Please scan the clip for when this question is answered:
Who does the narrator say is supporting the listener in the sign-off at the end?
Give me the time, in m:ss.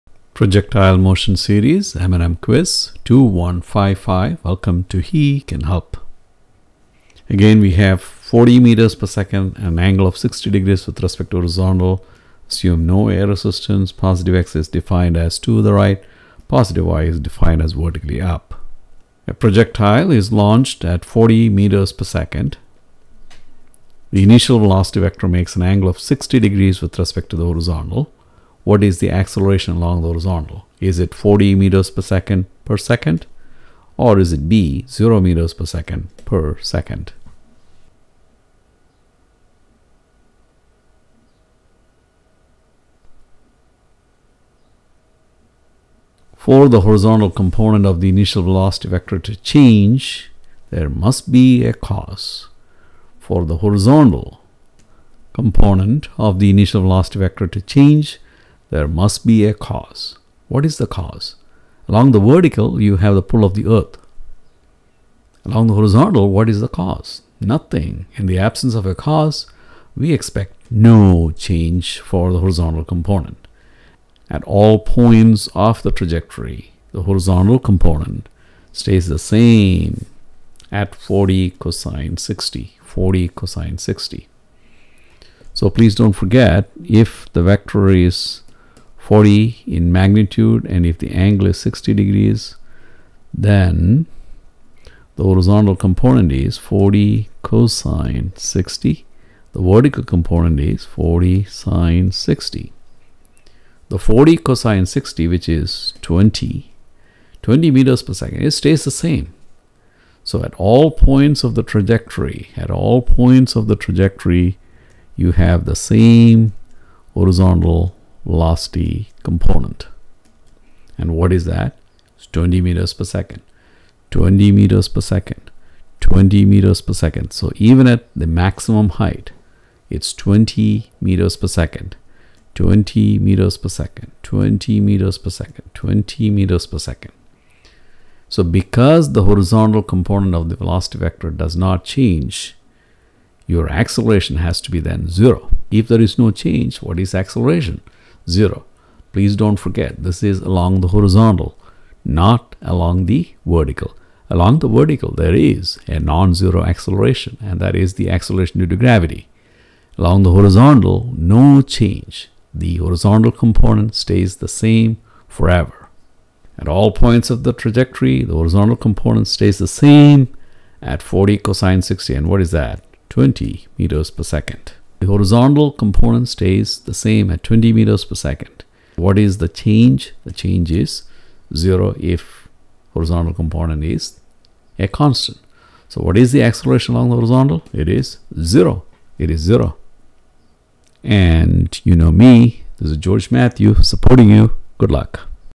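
3:12.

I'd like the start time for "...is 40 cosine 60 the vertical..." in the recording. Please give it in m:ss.
1:36.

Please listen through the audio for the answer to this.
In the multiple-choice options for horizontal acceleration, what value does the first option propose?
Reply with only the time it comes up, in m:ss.
0:31.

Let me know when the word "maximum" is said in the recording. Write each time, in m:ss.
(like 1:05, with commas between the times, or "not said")
2:08.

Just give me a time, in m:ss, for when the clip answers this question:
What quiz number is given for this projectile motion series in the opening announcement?
0:03.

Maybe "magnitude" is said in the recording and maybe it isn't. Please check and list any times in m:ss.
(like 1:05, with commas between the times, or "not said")
1:29.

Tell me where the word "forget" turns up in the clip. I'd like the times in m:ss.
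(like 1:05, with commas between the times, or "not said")
1:26, 2:29.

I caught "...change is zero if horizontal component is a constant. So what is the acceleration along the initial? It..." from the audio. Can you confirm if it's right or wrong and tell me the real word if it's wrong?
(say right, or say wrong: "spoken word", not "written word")
wrong: "horizontal", not "initial".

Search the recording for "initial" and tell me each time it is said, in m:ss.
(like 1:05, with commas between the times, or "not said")
0:24, 0:48, 0:56.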